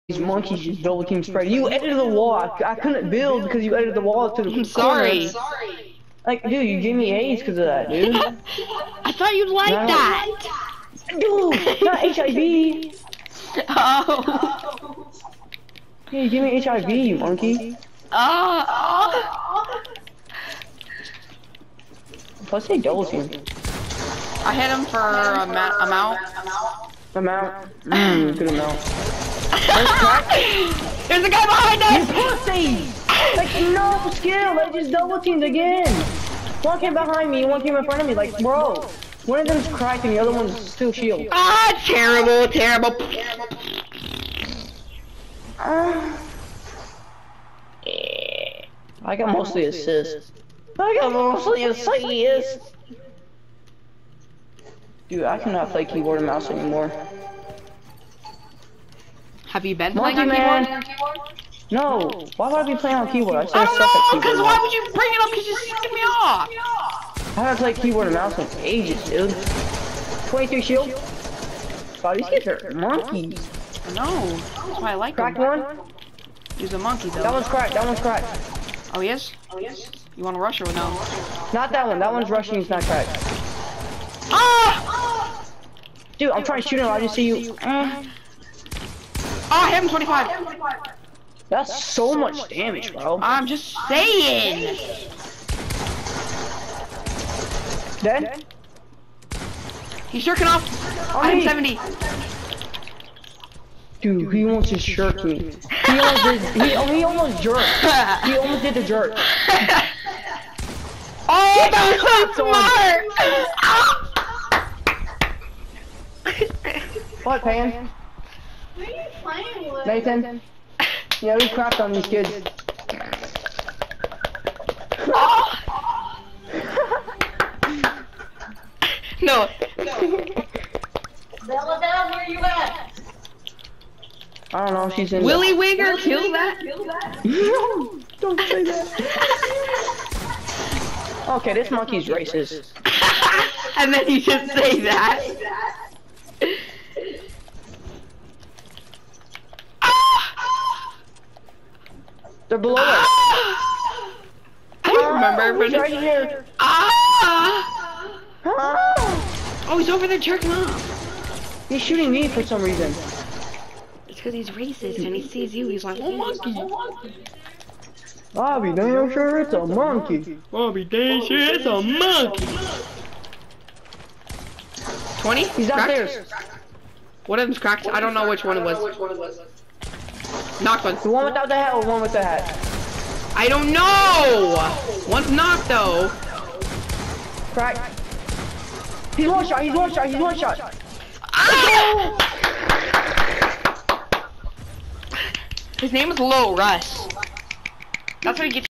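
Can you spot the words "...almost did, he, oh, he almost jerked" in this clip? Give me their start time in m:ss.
1:45.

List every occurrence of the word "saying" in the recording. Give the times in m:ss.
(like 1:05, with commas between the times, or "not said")
1:33.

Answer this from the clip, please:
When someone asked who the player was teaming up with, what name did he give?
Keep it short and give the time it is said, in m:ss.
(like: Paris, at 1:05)
Nathan, at 1:59.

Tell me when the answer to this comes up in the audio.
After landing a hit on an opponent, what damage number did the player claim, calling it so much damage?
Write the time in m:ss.
1:29.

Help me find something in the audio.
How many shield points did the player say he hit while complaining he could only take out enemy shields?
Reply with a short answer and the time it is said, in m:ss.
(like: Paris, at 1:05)
23, at 1:10.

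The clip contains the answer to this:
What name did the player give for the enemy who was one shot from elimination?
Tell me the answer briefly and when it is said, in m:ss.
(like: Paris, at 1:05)
Low Russ, at 3:16.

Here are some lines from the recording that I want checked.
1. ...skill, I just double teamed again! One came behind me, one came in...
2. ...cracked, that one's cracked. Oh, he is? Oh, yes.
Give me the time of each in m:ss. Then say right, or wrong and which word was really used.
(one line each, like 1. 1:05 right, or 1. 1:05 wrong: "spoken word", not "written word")
1. 0:34 right
2. 1:17 right.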